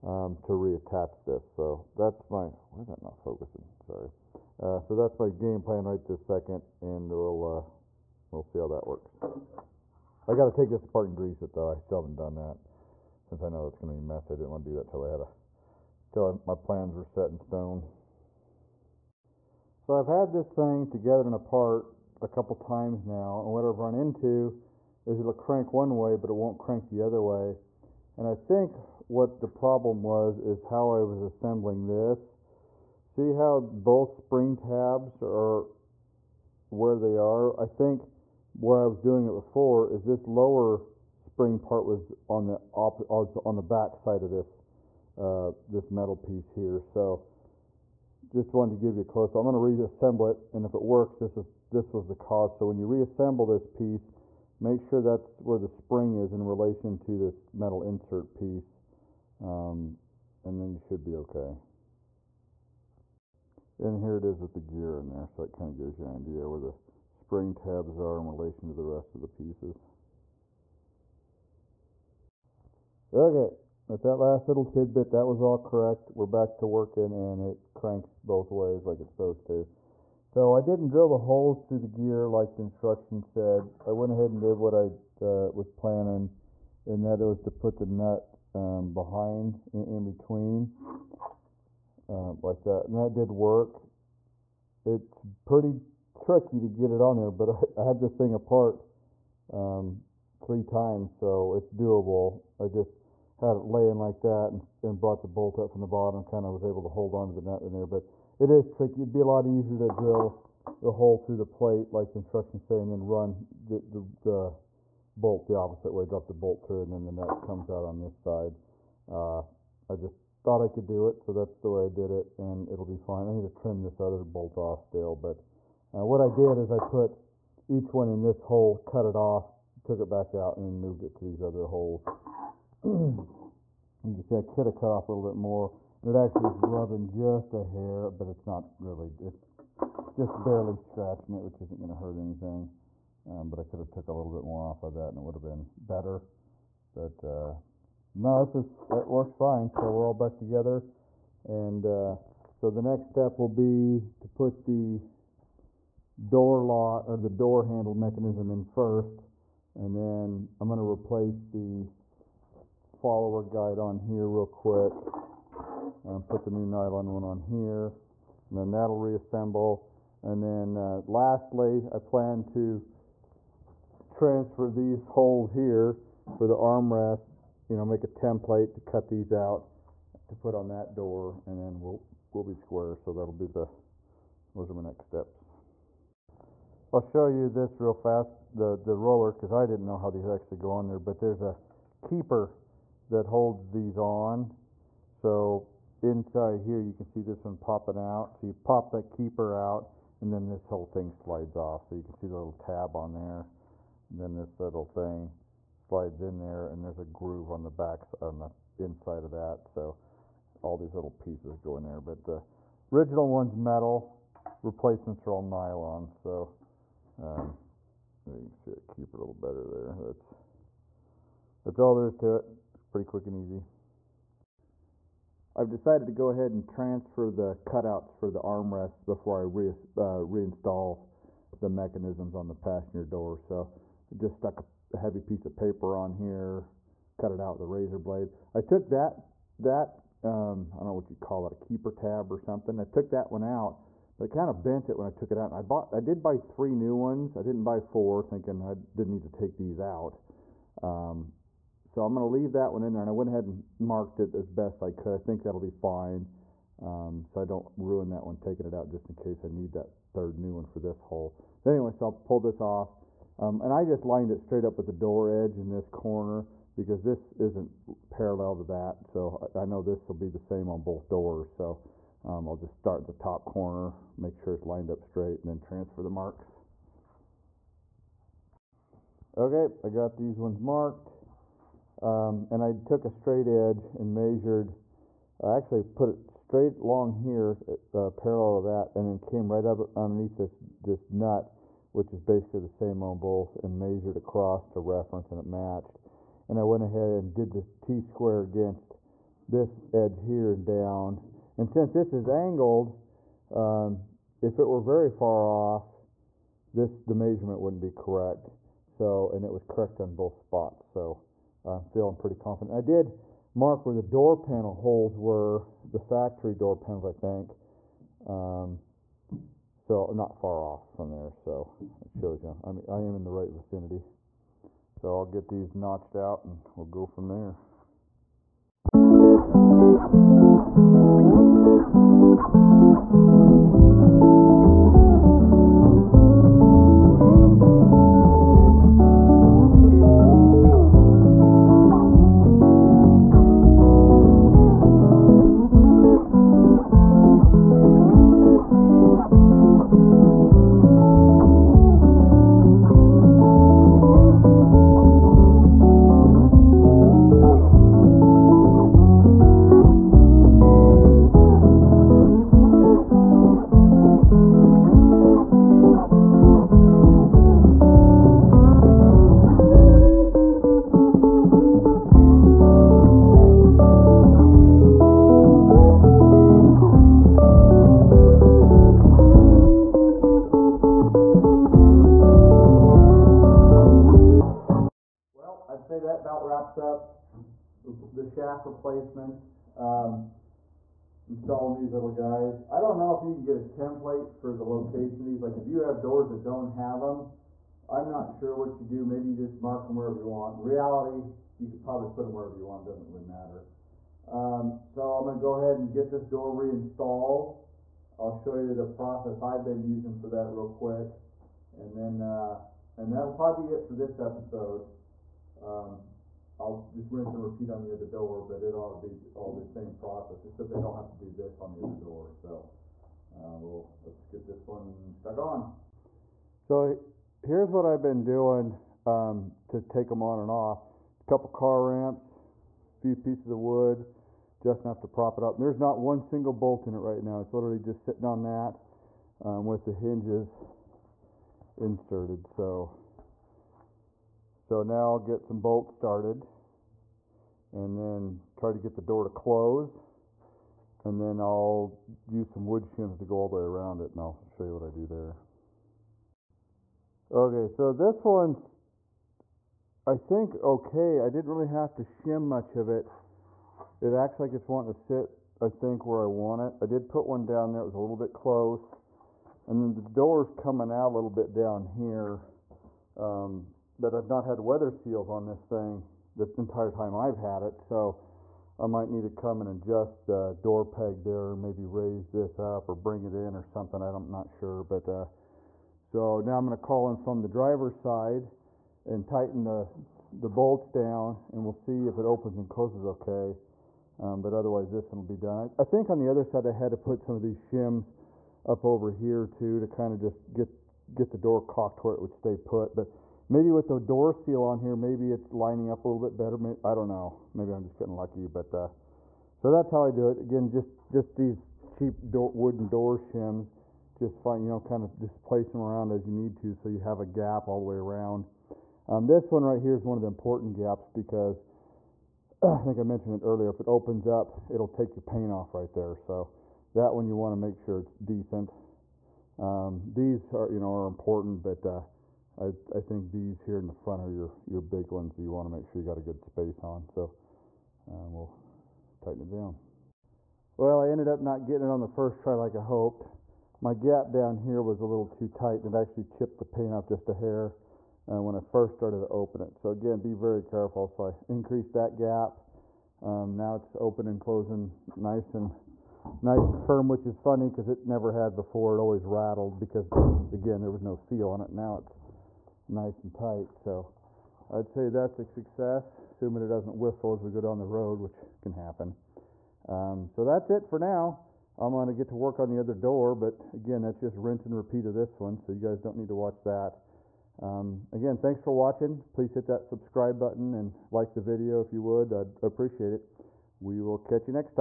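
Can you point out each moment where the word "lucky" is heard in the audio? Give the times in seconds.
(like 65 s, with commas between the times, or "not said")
508 s.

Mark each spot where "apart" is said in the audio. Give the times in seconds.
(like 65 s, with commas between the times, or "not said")
10 s, 21 s, 98 s.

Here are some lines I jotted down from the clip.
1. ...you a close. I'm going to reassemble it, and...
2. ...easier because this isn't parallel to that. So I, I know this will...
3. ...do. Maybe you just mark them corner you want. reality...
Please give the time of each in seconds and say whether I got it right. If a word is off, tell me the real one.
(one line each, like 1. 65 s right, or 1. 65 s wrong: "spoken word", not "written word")
1. 48 s right
2. 265 s wrong: "corner", not "easier"
3. 398 s wrong: "wherever", not "corner".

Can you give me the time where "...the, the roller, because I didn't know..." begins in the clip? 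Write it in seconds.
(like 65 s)
188 s.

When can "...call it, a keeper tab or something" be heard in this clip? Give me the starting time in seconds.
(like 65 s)
241 s.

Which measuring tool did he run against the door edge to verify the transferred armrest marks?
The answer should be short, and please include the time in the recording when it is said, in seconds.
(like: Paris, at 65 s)
T-square, at 297 s.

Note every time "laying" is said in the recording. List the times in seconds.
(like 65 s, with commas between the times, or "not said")
103 s.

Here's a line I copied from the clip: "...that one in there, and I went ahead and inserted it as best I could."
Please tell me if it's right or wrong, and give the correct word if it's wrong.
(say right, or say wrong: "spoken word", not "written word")
wrong: "marked", not "inserted".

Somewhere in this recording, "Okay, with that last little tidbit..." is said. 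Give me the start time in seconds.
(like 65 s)
73 s.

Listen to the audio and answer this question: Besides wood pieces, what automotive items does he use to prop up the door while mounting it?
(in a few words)
Car ramps.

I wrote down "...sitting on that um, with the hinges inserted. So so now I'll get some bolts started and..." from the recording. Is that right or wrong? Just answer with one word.
right.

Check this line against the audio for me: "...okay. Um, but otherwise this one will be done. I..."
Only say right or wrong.
right.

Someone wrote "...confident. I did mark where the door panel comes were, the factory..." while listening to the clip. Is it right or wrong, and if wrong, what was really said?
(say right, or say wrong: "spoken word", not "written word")
wrong: "holes", not "comes".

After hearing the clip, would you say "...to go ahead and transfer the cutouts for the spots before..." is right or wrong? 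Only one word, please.
wrong.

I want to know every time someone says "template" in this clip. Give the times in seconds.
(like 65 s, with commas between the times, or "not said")
178 s, 393 s.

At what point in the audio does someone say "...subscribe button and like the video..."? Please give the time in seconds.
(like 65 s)
579 s.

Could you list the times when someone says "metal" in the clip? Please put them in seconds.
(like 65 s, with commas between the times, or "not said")
45 s, 57 s, 213 s.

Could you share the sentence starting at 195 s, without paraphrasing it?
So inside here, you can see this one popping out.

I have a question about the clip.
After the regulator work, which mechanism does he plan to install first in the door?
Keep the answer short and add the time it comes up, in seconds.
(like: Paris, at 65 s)
Door handle mechanism, at 157 s.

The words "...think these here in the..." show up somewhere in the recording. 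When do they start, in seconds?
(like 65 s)
533 s.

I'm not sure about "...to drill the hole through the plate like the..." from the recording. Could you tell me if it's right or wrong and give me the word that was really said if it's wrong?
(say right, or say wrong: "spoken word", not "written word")
right.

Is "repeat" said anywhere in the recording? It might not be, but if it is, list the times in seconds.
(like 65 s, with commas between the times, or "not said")
417 s, 574 s.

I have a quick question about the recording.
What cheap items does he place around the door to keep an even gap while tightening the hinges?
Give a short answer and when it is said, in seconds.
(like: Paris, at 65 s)
Wooden door shims, at 512 s.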